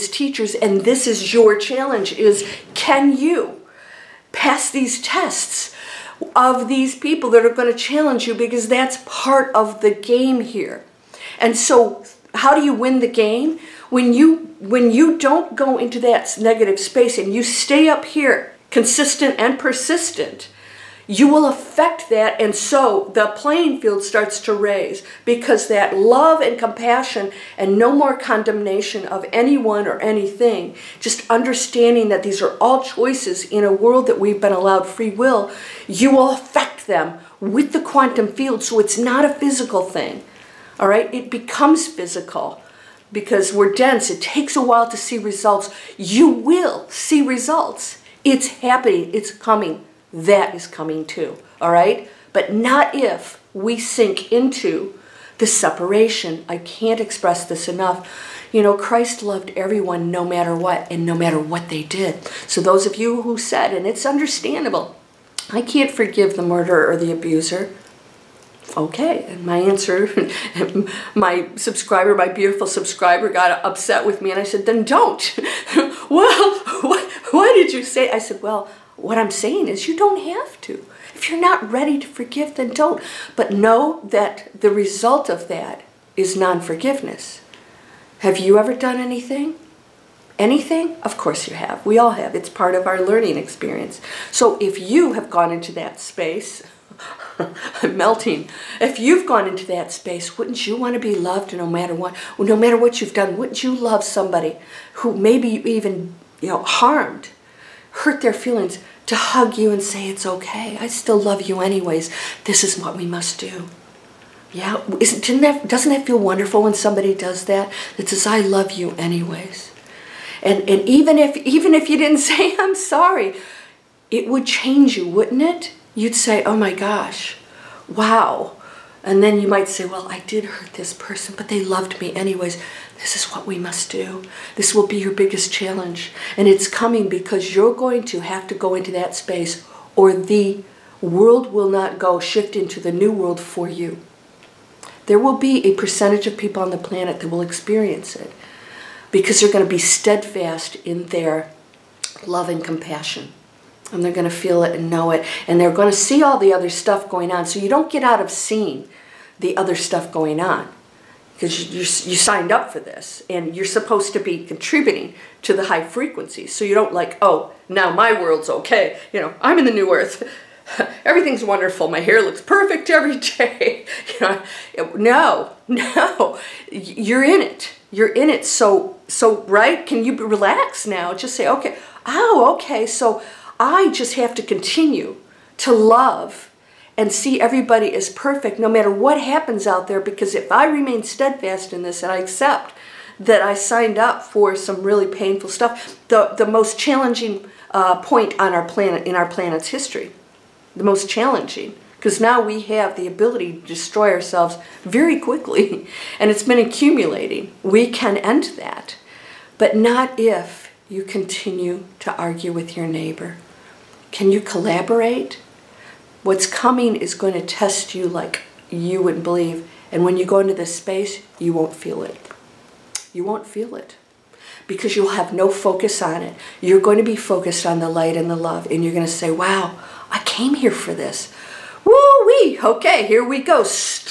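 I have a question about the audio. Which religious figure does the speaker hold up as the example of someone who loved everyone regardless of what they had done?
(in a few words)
Christ.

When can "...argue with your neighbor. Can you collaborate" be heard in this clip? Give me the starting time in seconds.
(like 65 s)
212 s.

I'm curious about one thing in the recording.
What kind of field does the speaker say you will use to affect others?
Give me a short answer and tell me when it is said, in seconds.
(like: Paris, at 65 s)
Quantum field, at 37 s.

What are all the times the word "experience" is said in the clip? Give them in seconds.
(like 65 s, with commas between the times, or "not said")
93 s, 147 s.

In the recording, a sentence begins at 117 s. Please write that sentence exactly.
That says, I love you anyways.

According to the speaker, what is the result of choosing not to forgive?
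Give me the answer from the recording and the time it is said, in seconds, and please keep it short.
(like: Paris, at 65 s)
Non-forgiveness, at 86 s.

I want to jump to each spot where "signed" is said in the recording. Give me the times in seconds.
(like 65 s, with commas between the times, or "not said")
162 s, 193 s.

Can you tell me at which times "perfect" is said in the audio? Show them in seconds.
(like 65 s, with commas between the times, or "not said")
172 s, 188 s.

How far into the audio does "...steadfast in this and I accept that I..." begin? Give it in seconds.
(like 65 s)
191 s.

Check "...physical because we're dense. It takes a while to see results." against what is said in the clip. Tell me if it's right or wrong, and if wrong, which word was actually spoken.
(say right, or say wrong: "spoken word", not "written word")
right.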